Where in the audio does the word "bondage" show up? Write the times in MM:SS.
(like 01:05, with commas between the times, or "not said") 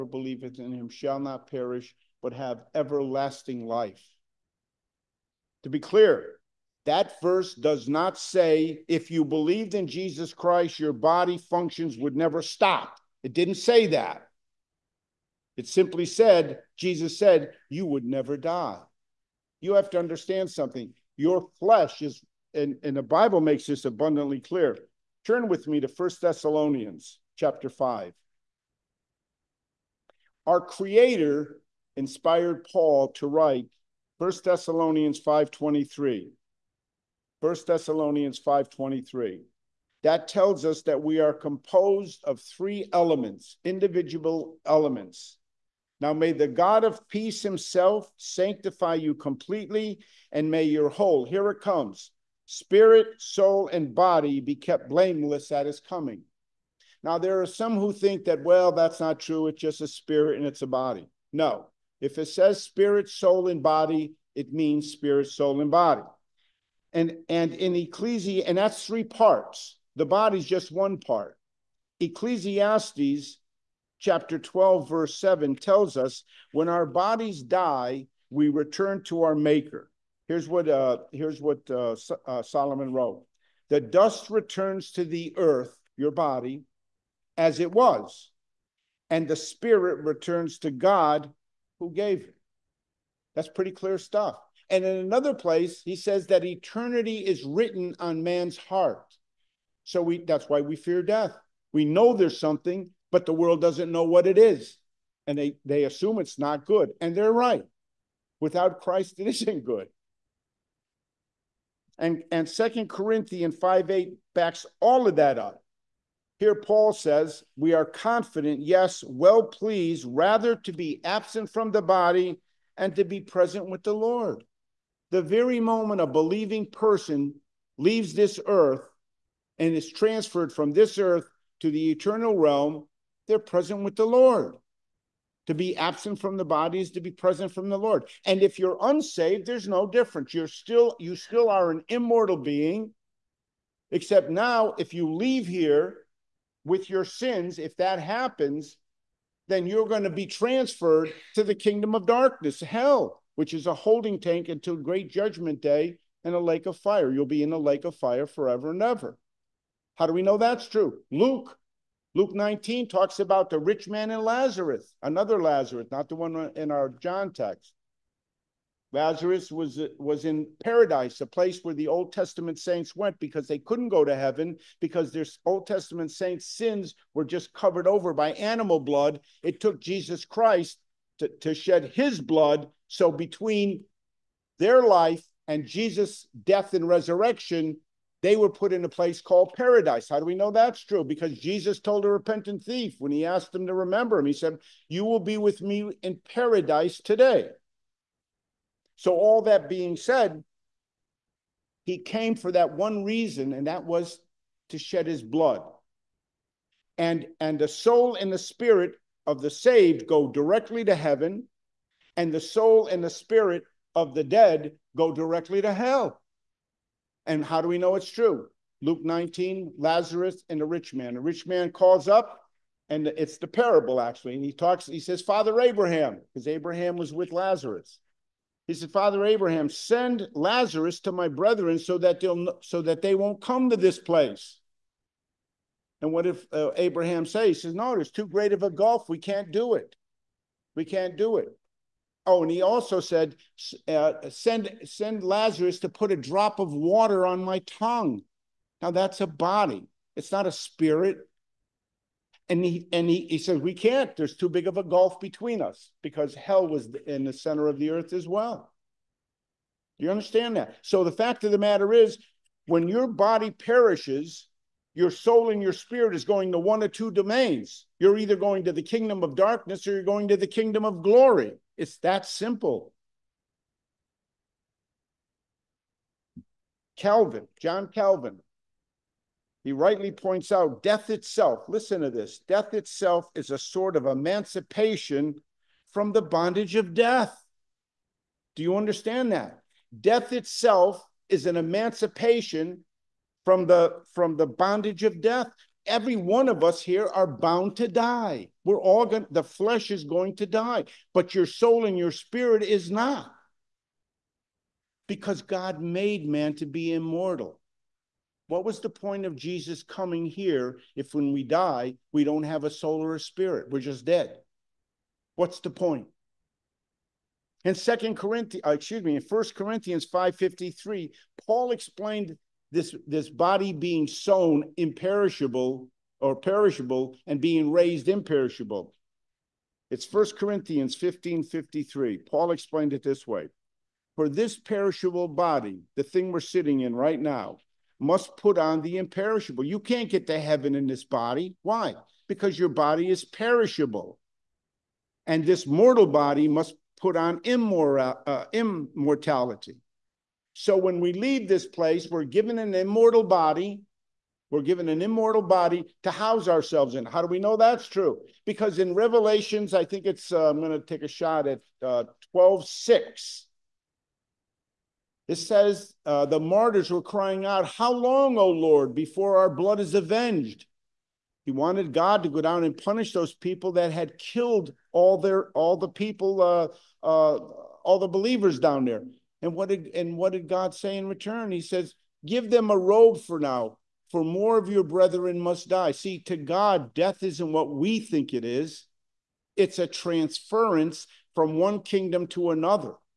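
04:46, 04:54.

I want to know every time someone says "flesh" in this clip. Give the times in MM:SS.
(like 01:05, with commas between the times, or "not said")
00:21, 04:59.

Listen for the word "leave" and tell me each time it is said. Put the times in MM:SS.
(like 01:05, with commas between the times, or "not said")
02:07, 02:25, 05:51.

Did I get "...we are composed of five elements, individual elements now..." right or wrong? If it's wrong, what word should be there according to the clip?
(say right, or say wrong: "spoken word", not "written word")
wrong: "three", not "five".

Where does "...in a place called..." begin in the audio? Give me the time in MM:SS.
03:08.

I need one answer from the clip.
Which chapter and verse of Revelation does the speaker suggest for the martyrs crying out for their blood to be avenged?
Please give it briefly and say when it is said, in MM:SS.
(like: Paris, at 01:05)
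12:6, at 06:02.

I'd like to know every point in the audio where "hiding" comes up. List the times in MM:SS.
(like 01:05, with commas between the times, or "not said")
not said.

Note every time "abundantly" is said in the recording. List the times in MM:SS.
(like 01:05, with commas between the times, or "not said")
00:23.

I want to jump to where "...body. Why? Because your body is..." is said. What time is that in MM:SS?
05:41.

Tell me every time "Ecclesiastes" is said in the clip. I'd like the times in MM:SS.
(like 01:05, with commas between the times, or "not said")
01:07, 01:11.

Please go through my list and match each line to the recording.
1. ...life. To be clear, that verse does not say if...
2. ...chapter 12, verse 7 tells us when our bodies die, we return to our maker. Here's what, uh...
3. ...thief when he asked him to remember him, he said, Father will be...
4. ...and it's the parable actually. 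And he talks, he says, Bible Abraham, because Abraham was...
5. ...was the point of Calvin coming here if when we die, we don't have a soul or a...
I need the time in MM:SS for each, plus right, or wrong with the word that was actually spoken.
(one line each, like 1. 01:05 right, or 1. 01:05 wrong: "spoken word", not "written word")
1. 00:03 right
2. 01:14 right
3. 03:12 wrong: "You", not "Father"
4. 03:42 wrong: "Father", not "Bible"
5. 05:08 wrong: "Jesus", not "Calvin".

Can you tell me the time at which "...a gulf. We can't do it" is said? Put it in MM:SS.
03:58.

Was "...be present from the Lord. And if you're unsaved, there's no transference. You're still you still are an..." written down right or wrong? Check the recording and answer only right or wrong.
wrong.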